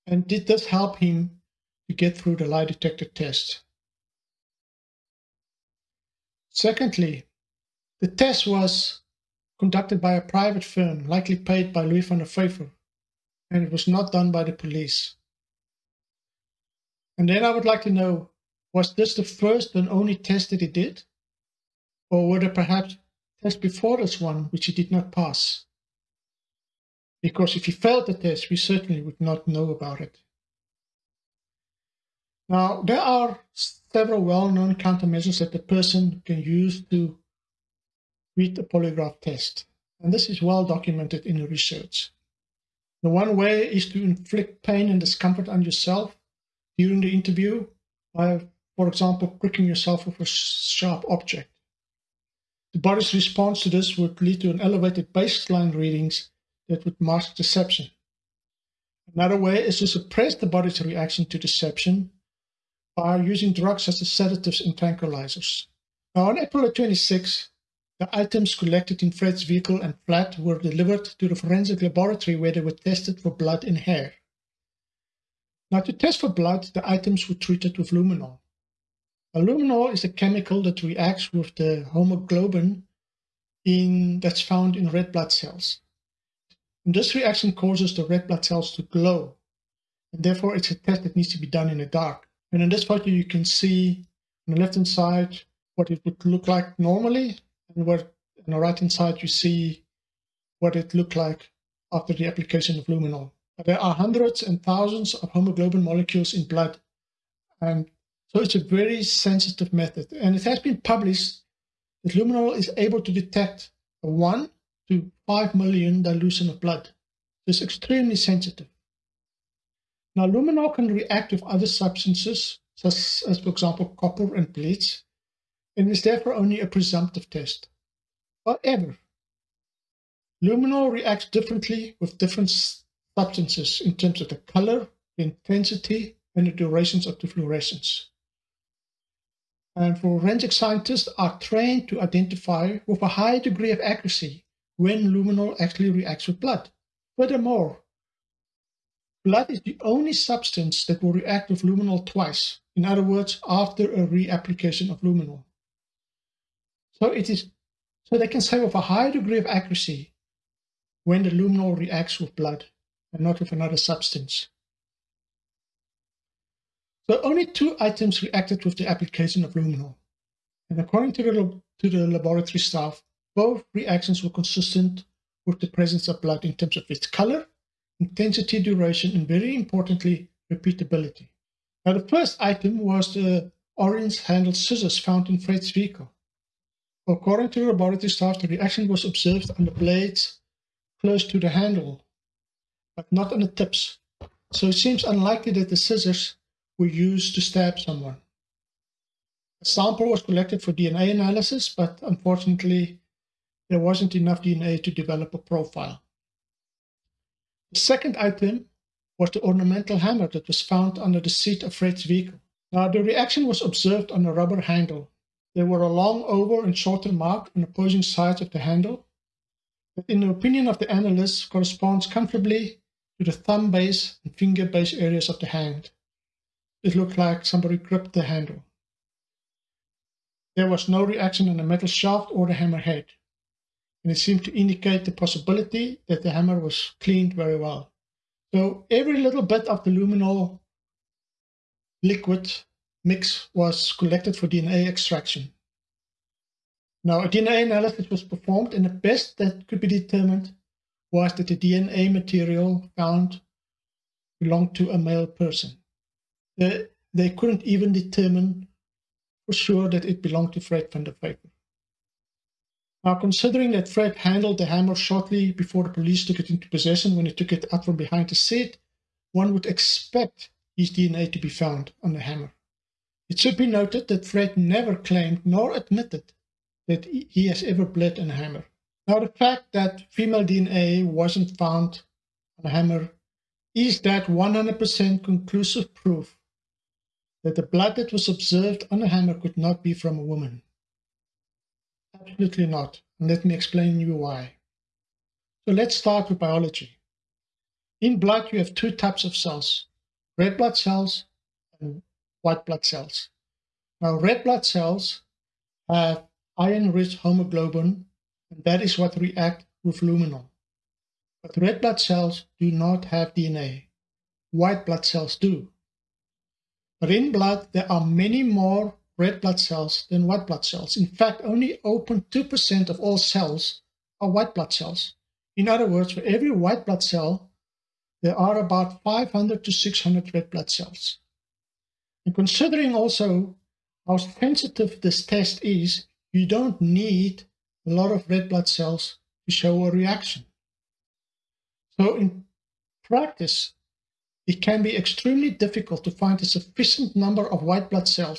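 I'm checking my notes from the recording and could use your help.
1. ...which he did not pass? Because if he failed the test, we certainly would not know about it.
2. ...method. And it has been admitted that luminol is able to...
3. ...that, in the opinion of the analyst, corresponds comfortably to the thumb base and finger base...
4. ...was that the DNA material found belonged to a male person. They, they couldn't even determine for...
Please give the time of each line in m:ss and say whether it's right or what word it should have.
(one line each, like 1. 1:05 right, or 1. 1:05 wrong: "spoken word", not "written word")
1. 0:24 right
2. 1:49 wrong: "published", not "admitted"
3. 3:39 right
4. 4:11 right.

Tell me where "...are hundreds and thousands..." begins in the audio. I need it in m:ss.
1:43.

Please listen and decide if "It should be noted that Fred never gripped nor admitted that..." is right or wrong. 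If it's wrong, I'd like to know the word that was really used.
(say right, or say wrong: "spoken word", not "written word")
wrong: "claimed", not "gripped".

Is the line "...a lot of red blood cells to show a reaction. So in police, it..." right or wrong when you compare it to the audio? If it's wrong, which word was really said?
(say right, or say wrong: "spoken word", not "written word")
wrong: "practice", not "police".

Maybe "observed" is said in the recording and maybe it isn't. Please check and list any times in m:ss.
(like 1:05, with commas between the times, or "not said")
3:09, 3:33, 4:48.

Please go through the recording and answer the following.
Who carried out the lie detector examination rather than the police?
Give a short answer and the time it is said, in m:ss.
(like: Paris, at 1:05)
A private firm, at 0:10.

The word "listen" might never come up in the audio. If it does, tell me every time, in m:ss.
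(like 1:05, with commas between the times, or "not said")
not said.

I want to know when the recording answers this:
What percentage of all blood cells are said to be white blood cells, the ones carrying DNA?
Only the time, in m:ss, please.
5:21.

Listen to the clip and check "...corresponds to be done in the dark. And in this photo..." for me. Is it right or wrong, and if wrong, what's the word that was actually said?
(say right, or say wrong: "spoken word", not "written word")
wrong: "needs", not "corresponds".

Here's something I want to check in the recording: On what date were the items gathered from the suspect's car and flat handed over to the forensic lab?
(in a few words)
April 26.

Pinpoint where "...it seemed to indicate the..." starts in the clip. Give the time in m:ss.
3:54.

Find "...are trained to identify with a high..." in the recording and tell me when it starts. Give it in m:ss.
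2:21.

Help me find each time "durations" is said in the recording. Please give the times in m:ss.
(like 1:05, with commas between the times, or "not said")
2:16, 2:58.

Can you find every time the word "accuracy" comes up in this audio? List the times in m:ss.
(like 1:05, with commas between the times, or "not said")
2:23, 2:39.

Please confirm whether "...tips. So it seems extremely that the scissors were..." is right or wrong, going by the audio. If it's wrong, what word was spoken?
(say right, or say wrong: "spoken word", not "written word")
wrong: "unlikely", not "extremely".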